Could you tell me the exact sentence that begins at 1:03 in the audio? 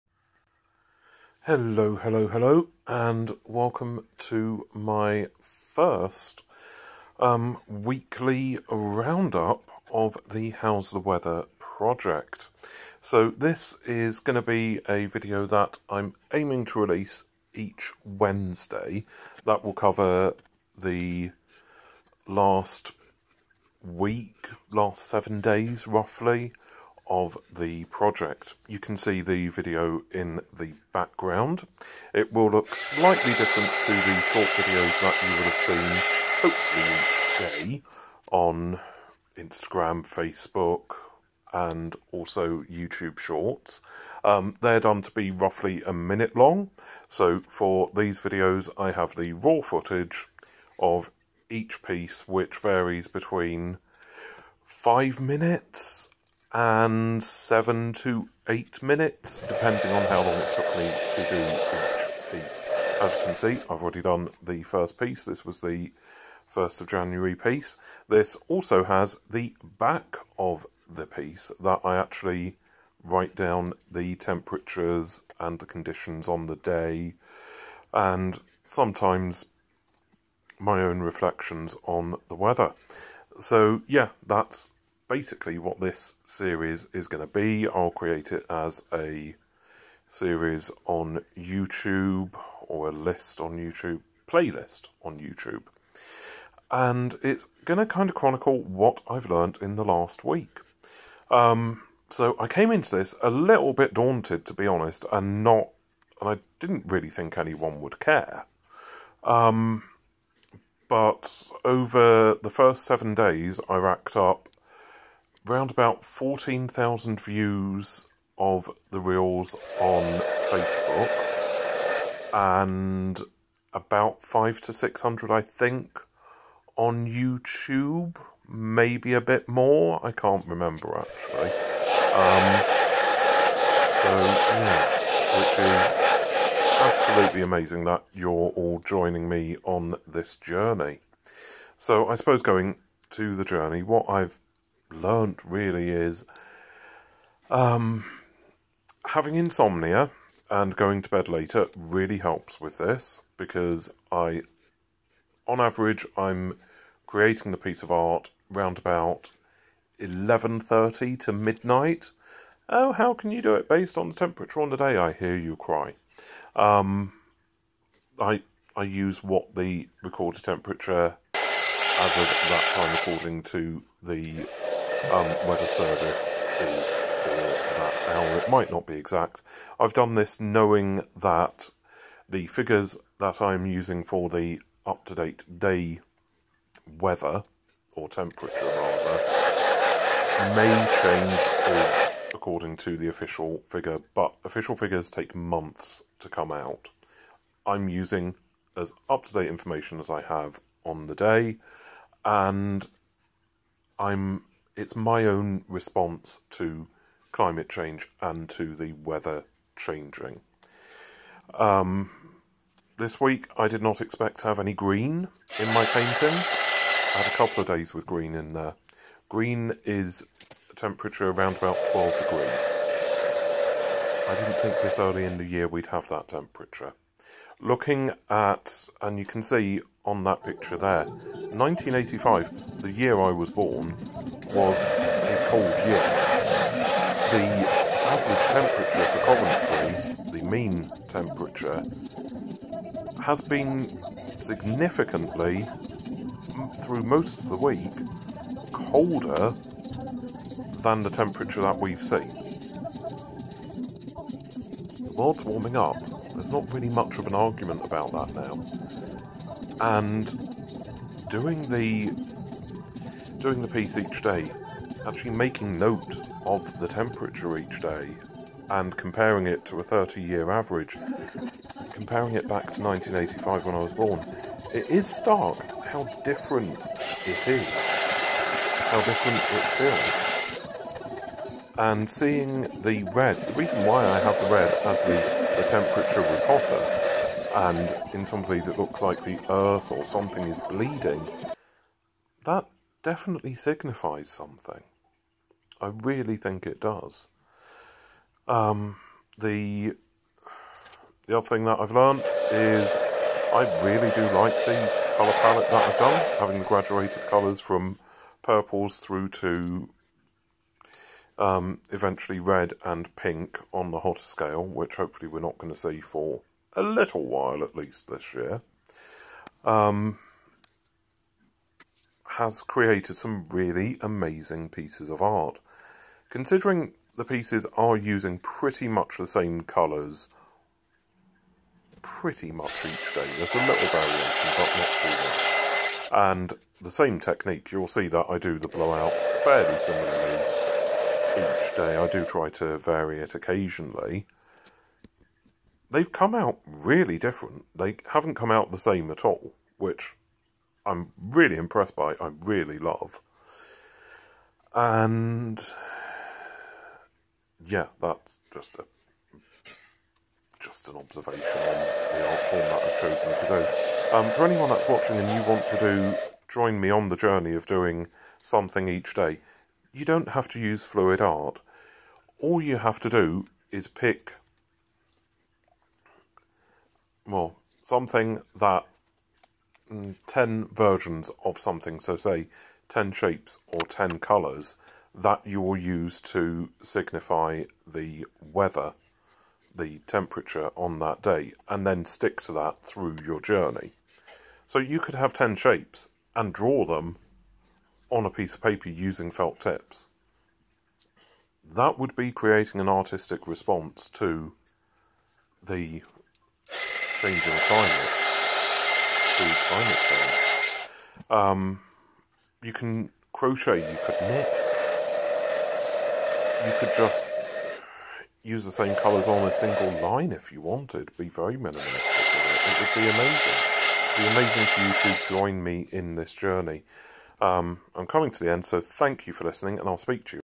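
As you can see, I've already done the first piece.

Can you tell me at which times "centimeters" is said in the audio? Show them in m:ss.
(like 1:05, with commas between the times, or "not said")
not said.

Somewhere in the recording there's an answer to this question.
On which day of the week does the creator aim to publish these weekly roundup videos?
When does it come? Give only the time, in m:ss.
0:18.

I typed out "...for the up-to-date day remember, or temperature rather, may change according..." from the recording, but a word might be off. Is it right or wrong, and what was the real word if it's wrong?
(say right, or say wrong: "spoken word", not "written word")
wrong: "weather", not "remember".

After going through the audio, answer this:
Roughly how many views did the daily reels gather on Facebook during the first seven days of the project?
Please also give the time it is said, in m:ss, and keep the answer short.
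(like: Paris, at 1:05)
14,000, at 1:56.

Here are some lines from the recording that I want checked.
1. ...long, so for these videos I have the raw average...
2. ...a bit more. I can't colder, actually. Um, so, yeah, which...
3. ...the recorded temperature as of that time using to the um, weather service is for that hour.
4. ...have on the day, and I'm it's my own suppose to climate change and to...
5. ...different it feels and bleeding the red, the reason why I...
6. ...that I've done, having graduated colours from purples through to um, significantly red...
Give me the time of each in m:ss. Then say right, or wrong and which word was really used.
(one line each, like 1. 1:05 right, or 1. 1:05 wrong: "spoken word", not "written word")
1. 0:46 wrong: "footage", not "average"
2. 2:09 wrong: "remember", not "colder"
3. 2:49 wrong: "according", not "using"
4. 3:20 wrong: "response", not "suppose"
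5. 4:39 wrong: "seeing", not "bleeding"
6. 5:05 wrong: "eventually", not "significantly".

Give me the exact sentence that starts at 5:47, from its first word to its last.
They haven't come out the same at all, which I'm really impressed by, I really love.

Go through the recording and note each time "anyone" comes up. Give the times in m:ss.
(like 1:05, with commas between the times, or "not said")
1:47, 6:04.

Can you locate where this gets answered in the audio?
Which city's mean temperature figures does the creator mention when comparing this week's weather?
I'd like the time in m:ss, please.
4:00.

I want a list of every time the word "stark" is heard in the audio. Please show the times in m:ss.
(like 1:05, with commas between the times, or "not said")
4:35.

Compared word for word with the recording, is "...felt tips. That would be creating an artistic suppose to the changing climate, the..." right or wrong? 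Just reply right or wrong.
wrong.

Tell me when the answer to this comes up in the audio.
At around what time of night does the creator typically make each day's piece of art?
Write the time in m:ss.
2:39.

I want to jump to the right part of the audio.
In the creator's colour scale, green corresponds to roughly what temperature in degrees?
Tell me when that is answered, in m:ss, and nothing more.
3:41.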